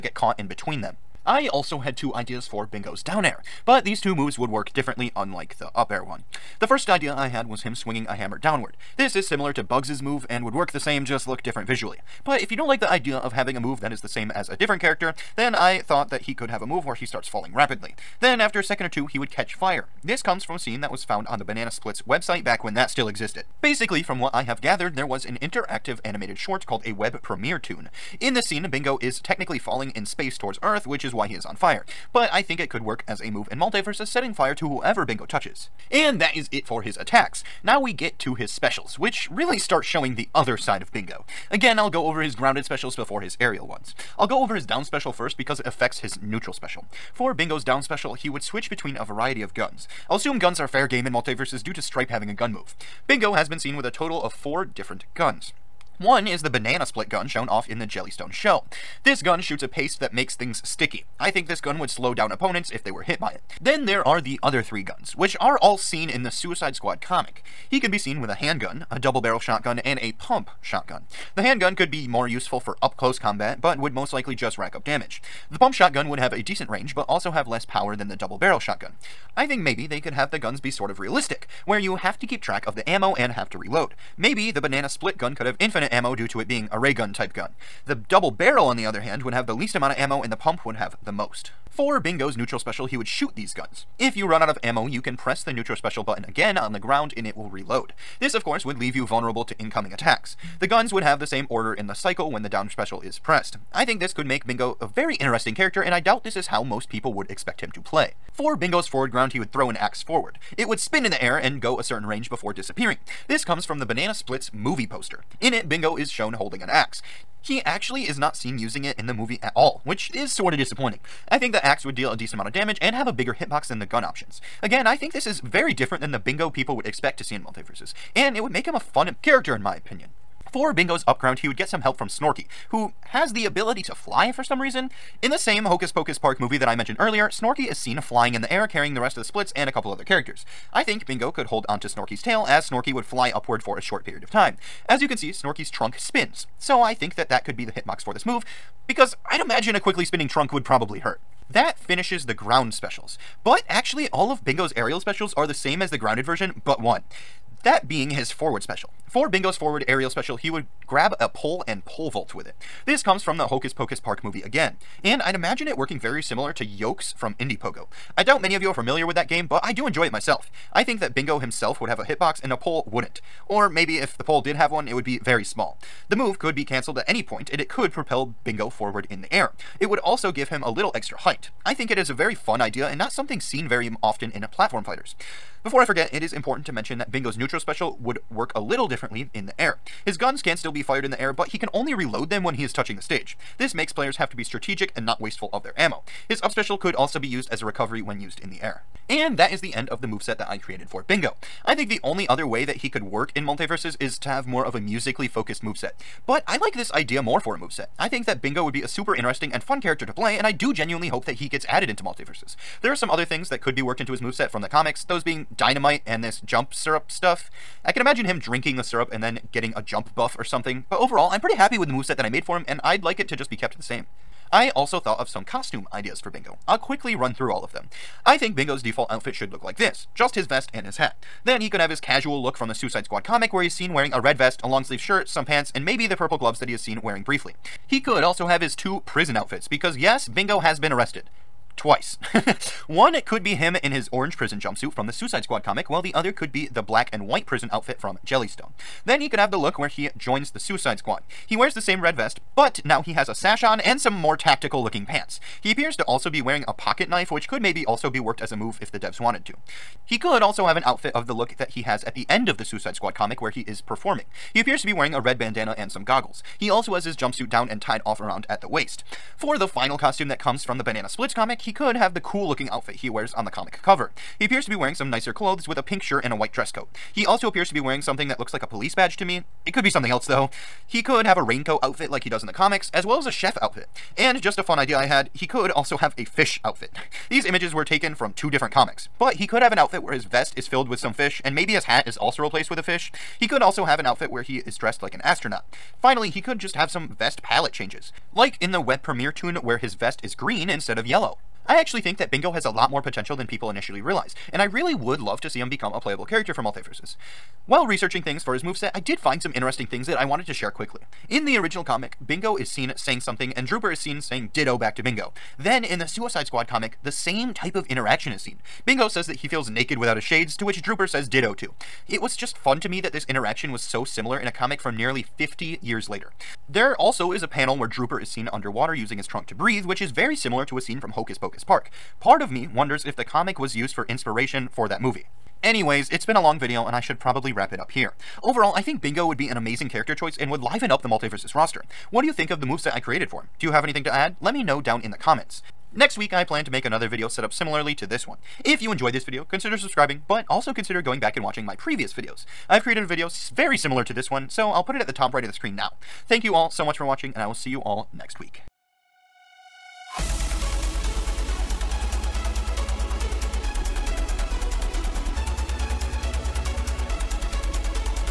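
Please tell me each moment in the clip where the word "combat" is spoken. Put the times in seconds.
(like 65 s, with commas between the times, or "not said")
73 s.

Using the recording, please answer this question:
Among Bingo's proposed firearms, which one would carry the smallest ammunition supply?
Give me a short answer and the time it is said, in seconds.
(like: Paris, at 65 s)
double barrel, at 87 s.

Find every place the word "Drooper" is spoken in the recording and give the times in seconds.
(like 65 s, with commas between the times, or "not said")
313 s, 320 s, 327 s.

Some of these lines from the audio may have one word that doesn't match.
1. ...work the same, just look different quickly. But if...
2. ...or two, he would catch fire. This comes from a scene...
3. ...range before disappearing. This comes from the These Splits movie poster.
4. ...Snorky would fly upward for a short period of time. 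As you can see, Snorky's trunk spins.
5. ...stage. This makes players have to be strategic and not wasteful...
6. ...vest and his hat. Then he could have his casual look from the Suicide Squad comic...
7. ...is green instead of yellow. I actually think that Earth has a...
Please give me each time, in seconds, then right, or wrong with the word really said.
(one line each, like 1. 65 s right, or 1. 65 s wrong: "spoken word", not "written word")
1. 10 s wrong: "visually", not "quickly"
2. 18 s right
3. 112 s wrong: "Banana", not "These"
4. 142 s right
5. 193 s right
6. 230 s right
7. 300 s wrong: "Bingo", not "Earth".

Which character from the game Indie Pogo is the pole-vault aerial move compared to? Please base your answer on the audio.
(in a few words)
Yokes.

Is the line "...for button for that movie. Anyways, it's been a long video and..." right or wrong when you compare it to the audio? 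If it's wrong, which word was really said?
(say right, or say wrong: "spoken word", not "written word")
wrong: "inspiration", not "button".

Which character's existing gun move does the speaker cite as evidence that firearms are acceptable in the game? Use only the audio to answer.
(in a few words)
Stripe.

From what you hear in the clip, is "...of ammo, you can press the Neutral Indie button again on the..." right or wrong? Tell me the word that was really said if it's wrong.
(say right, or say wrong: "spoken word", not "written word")
wrong: "Special", not "Indie".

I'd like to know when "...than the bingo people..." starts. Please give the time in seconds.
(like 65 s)
125 s.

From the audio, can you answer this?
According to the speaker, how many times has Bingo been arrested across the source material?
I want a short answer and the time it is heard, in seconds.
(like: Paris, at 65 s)
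2, at 241 s.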